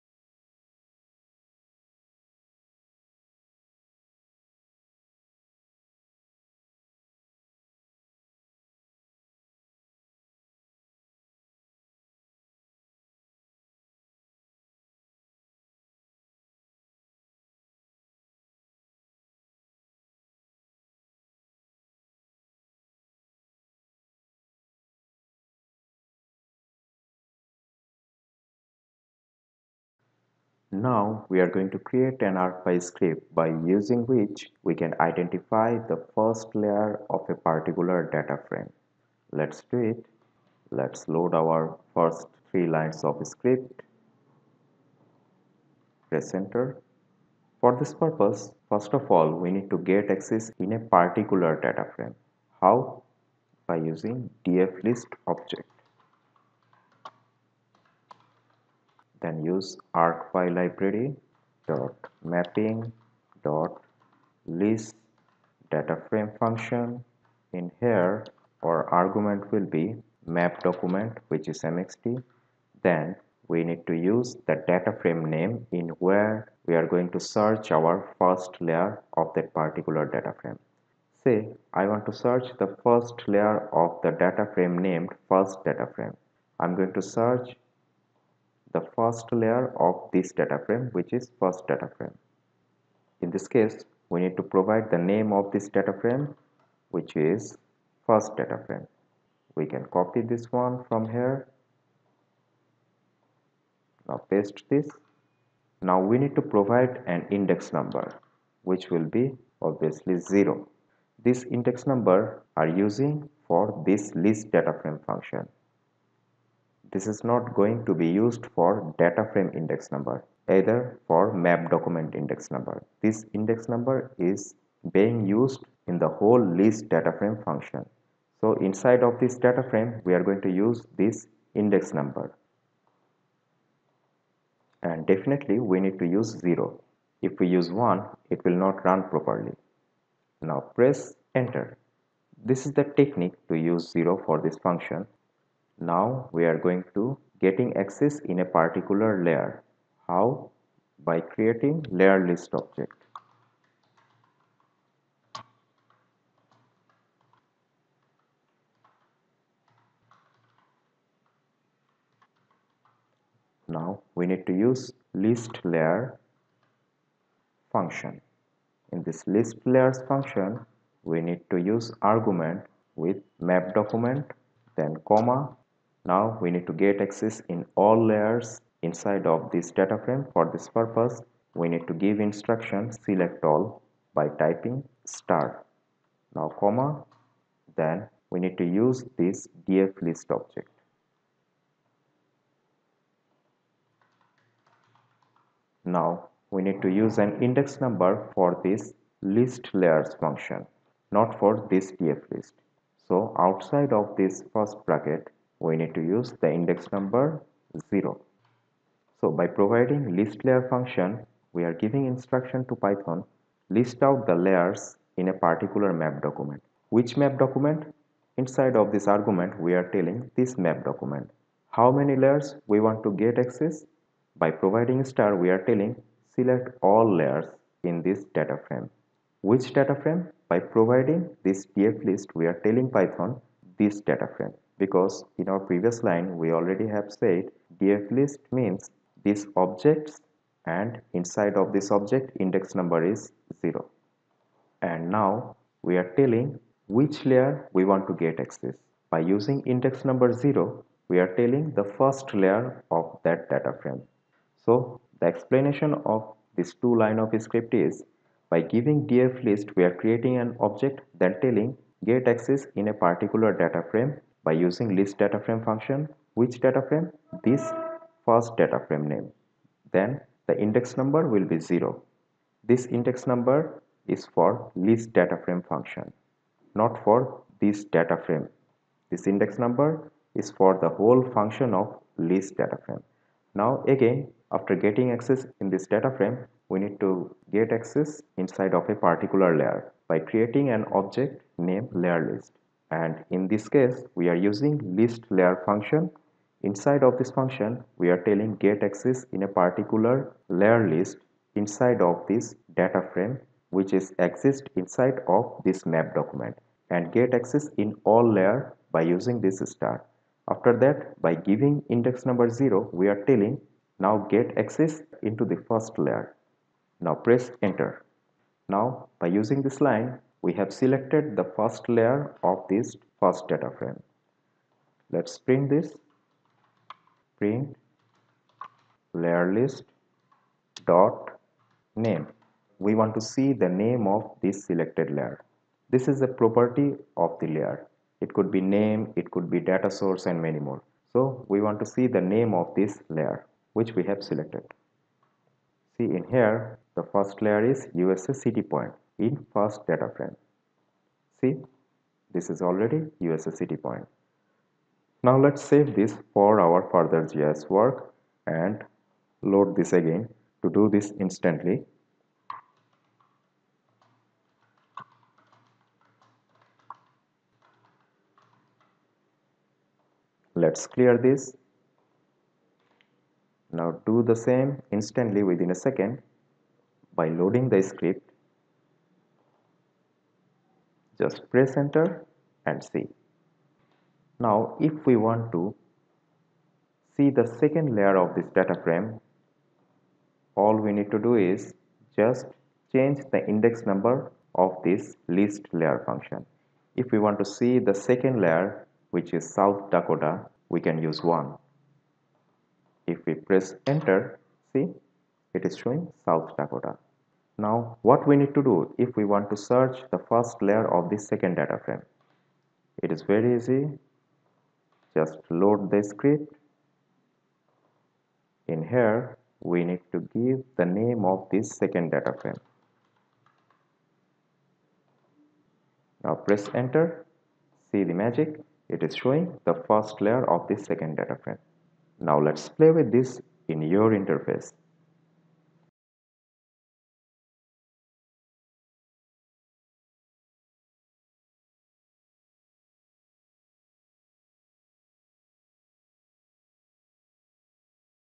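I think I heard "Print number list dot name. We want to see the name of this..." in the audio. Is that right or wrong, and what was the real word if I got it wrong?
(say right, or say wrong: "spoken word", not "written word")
wrong: "layer", not "number".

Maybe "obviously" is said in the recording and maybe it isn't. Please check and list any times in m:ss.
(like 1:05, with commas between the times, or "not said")
1:49.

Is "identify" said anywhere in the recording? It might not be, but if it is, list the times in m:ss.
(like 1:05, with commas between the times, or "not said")
0:35.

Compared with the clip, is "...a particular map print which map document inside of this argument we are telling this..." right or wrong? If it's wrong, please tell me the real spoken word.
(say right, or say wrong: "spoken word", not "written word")
wrong: "document", not "print".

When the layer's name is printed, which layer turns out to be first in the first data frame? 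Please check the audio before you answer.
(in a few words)
USA city point.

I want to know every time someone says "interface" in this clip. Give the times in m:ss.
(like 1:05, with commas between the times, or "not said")
7:14.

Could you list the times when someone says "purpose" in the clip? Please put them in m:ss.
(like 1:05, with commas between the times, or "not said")
0:47, 3:00.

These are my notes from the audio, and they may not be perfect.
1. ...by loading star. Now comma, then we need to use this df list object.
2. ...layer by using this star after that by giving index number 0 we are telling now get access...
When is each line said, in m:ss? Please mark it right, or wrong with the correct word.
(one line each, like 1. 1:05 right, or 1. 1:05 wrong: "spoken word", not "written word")
1. 3:04 wrong: "typing", not "loading"
2. 5:08 right.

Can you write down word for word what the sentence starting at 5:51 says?
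See, this is already city point.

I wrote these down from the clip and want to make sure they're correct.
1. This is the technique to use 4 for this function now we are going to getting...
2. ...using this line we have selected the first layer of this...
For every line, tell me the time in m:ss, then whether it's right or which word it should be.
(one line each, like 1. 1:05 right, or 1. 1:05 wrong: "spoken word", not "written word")
1. 2:22 wrong: "0", not "4"
2. 5:19 right.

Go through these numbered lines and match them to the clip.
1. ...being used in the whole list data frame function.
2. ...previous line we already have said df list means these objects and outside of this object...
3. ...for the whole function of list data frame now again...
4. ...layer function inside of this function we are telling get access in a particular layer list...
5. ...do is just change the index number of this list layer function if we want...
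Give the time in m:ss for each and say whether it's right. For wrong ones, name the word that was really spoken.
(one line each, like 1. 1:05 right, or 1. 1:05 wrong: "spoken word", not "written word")
1. 2:04 right
2. 3:55 wrong: "inside", not "outside"
3. 4:40 right
4. 4:55 right
5. 6:31 right.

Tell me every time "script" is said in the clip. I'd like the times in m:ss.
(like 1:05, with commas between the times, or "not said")
0:32, 0:43, 4:17, 6:17, 6:56.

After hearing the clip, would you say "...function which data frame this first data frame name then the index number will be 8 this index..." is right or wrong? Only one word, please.
wrong.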